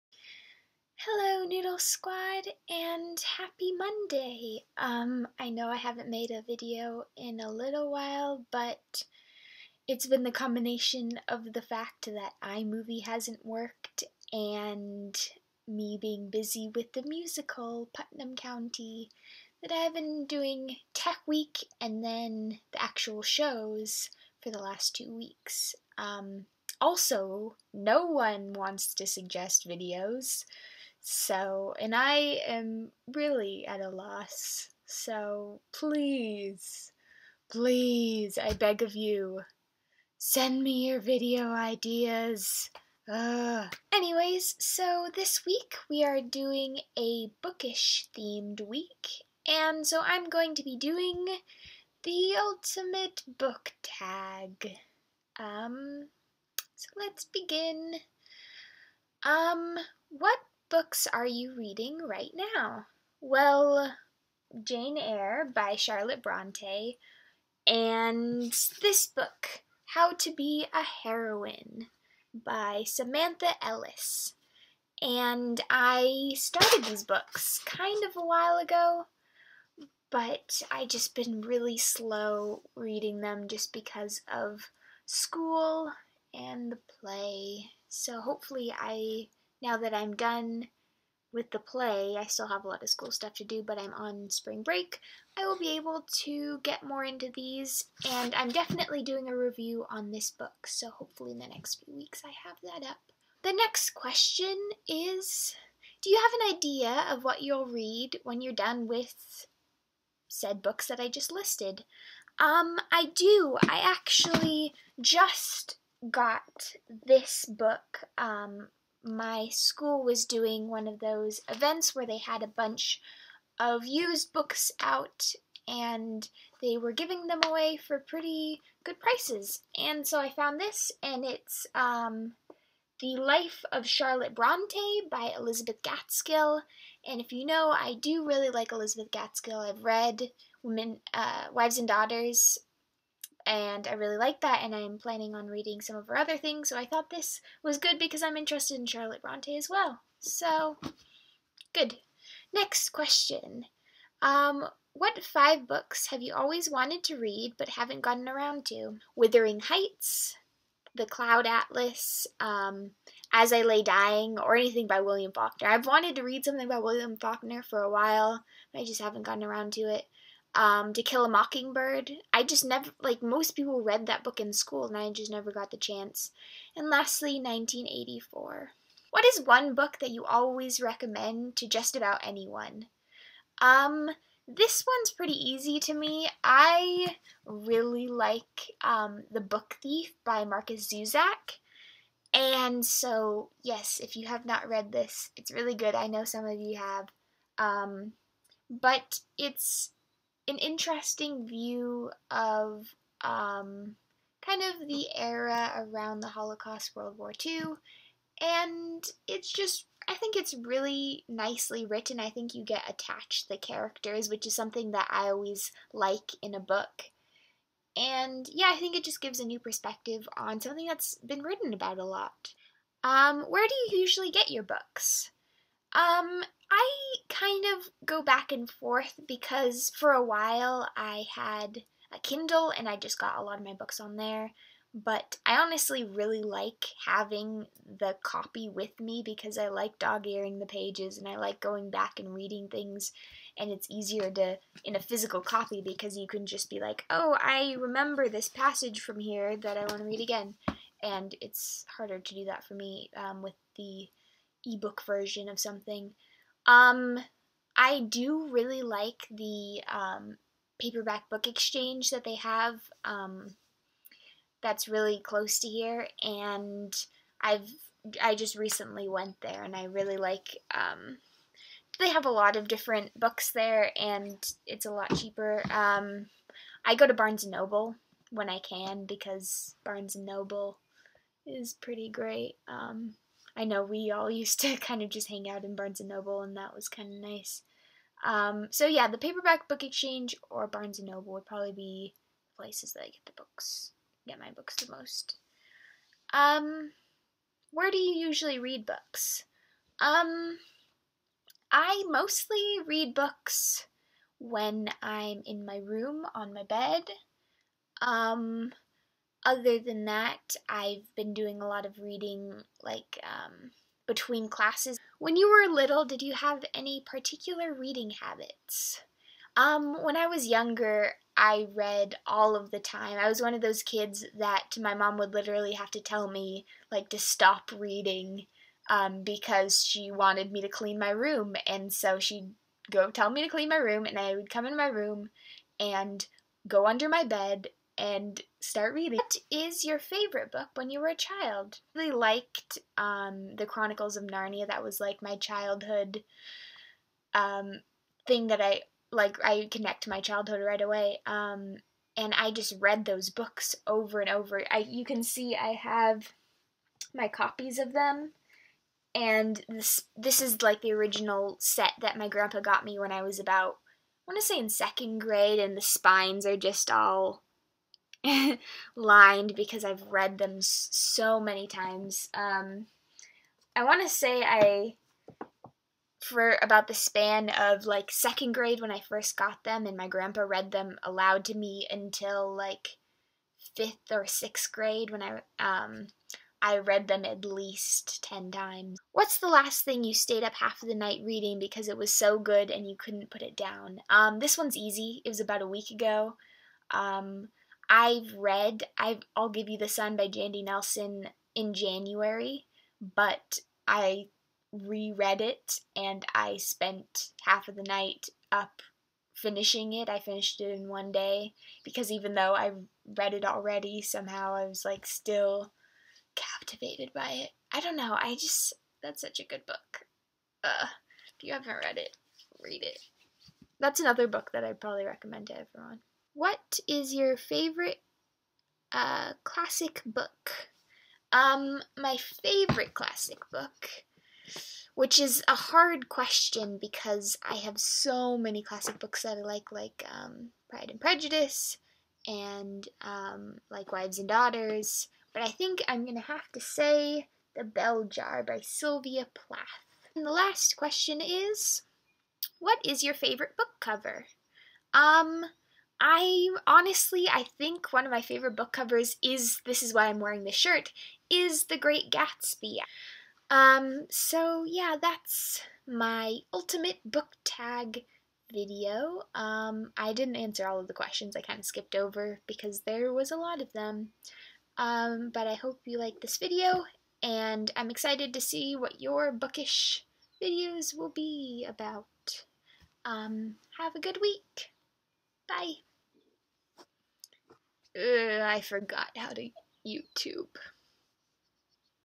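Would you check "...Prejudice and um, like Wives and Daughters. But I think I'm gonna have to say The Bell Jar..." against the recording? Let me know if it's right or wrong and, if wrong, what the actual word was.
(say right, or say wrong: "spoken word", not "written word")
right.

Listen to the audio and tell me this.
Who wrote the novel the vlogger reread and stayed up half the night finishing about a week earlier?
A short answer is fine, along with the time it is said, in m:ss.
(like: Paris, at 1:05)
Jandy Nelson, at 6:40.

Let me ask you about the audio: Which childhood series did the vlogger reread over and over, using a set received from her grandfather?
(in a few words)
The Chronicles of Narnia.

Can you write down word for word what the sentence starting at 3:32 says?
I think you get attached to the characters, which is something that I always like in a book.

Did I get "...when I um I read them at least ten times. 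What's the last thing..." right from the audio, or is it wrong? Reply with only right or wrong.
right.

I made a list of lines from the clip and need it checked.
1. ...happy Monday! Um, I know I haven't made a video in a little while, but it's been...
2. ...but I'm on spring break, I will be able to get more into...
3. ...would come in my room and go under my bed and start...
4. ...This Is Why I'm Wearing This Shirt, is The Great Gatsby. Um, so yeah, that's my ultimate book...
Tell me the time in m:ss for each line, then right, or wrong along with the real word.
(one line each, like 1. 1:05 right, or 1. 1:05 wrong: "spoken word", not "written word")
1. 0:03 right
2. 1:33 right
3. 5:34 right
4. 7:39 right.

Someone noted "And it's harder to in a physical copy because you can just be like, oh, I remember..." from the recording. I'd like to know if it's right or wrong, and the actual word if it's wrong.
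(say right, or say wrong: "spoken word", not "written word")
wrong: "easier", not "harder".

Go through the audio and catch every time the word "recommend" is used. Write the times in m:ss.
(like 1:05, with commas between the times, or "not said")
3:00, 7:05.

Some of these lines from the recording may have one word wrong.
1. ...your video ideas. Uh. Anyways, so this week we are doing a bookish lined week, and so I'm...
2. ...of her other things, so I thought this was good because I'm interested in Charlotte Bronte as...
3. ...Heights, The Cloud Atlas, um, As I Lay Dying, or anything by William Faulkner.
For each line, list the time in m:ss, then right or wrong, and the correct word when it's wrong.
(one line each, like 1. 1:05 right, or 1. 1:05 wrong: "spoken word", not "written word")
1. 0:40 wrong: "themed", not "lined"
2. 2:25 right
3. 2:39 right.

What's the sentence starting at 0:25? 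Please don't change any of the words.
Um, also, no one wants to suggest videos.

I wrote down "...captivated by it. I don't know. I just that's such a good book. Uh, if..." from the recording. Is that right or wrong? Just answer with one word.
right.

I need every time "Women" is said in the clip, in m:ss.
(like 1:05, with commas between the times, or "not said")
2:20.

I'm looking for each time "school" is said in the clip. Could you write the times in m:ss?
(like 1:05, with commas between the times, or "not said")
1:25, 1:32, 1:59, 2:54.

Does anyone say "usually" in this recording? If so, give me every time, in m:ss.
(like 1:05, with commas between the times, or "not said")
3:44, 4:58.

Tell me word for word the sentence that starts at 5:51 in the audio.
Um, and I just read those books over and over.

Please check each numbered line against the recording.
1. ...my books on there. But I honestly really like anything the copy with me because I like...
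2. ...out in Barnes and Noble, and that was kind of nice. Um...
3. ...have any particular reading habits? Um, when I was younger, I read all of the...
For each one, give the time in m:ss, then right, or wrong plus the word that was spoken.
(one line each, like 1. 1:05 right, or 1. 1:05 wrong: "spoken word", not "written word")
1. 3:53 wrong: "having", not "anything"
2. 4:45 right
3. 5:16 right.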